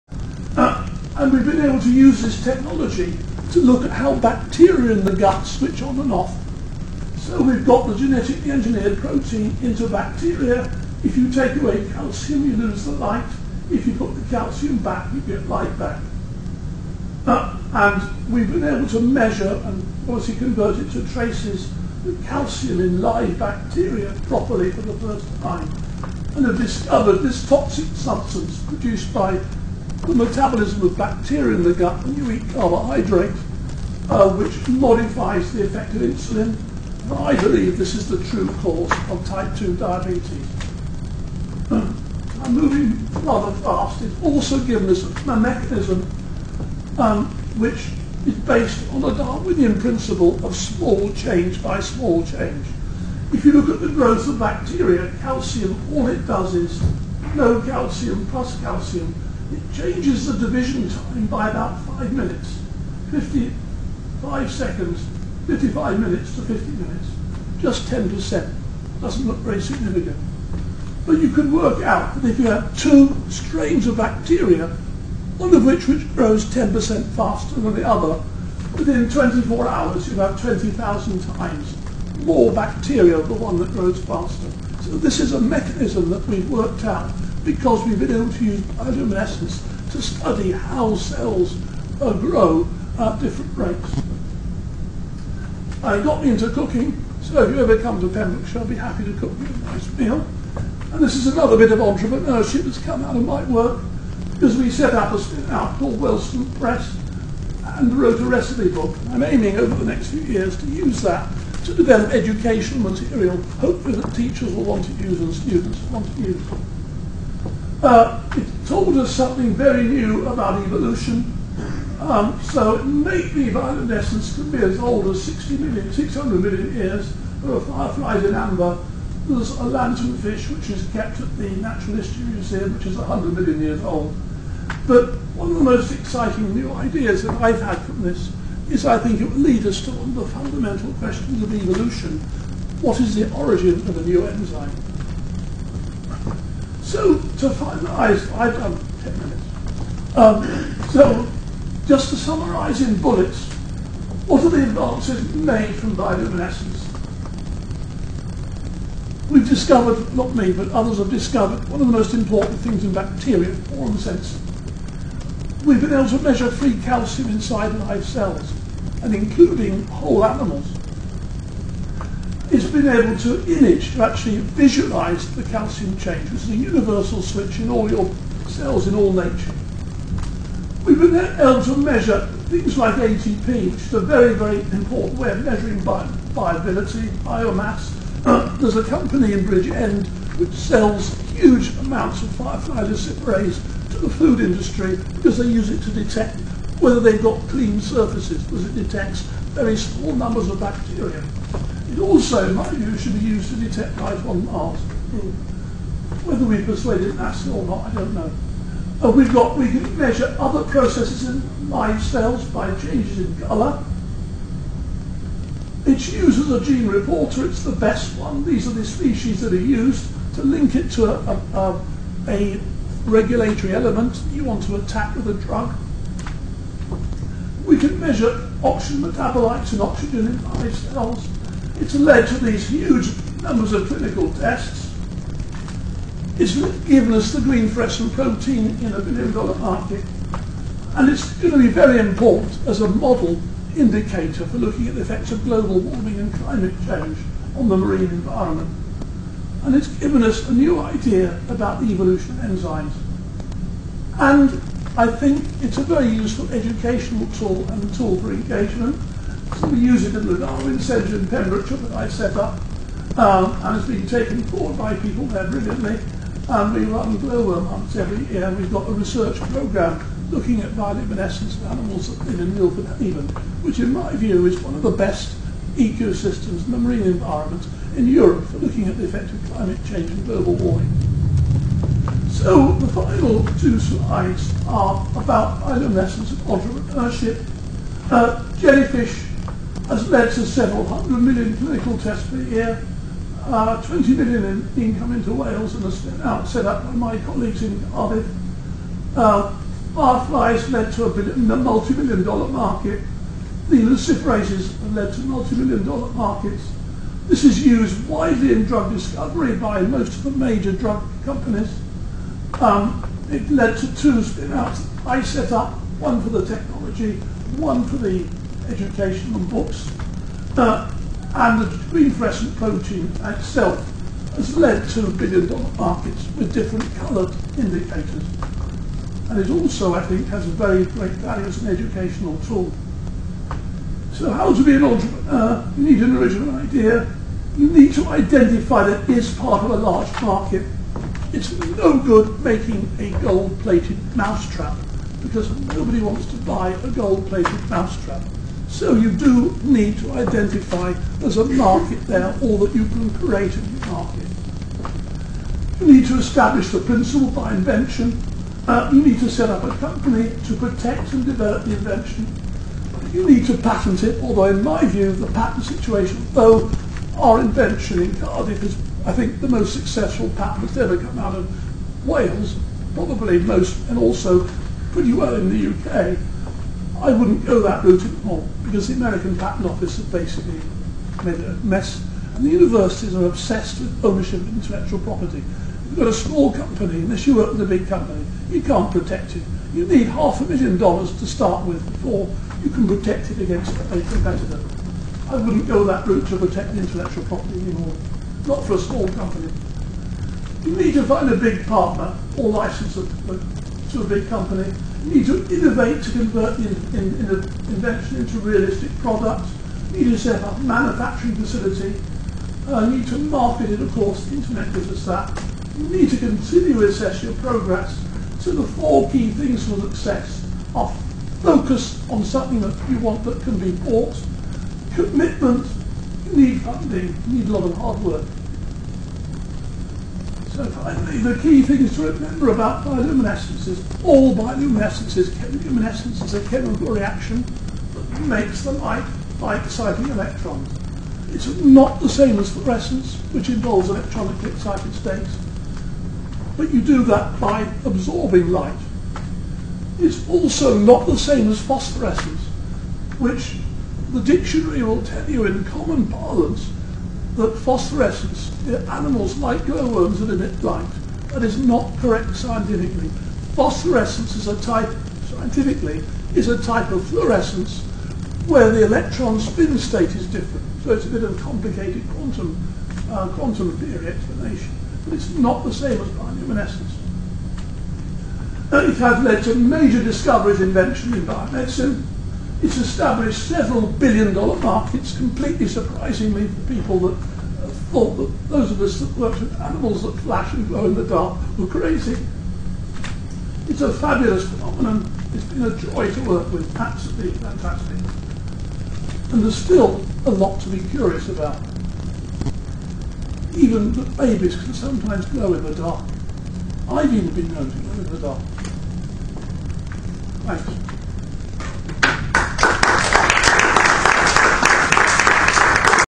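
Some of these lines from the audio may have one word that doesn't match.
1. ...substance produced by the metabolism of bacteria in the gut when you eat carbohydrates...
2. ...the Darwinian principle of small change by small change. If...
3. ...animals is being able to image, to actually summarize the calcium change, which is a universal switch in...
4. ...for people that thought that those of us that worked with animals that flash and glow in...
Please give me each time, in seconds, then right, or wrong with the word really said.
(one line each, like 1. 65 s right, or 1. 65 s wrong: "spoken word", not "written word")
1. 27 s right
2. 49 s right
3. 170 s wrong: "visualize", not "summarize"
4. 486 s right.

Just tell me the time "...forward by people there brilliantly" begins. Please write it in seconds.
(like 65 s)
264 s.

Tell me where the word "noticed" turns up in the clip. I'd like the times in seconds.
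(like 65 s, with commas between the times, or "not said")
not said.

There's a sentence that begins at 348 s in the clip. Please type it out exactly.
So you do need to identify there's a market there or that you can create a the market.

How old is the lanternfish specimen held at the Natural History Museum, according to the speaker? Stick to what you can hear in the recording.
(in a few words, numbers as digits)
100 million years.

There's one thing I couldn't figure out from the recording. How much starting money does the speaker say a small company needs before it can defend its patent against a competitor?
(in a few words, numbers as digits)
half a million dollars.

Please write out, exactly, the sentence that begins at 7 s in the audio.
So we've got the genetically engineered protein into bacteria.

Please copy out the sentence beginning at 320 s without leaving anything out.
Uh, and the green-fluorescent protein itself has led to billion-dollar markets with different coloured indicators.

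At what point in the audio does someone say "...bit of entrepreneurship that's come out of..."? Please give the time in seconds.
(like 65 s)
101 s.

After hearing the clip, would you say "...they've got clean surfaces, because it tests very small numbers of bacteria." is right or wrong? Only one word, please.
wrong.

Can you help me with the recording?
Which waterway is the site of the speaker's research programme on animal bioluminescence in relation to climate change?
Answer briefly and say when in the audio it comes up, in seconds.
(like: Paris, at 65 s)
Milford Haven, at 272 s.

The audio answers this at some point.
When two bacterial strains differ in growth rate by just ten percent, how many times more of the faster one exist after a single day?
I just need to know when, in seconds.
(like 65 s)
80 s.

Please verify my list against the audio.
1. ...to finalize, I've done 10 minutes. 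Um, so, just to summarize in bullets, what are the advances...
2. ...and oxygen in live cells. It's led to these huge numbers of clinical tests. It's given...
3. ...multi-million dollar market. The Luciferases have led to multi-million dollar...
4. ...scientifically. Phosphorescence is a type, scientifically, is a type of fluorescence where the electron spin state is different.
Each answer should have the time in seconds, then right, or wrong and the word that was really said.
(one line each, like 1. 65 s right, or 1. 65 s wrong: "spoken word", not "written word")
1. 147 s right
2. 229 s right
3. 301 s right
4. 462 s right.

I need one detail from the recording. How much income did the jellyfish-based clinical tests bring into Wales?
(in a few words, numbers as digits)
20 million.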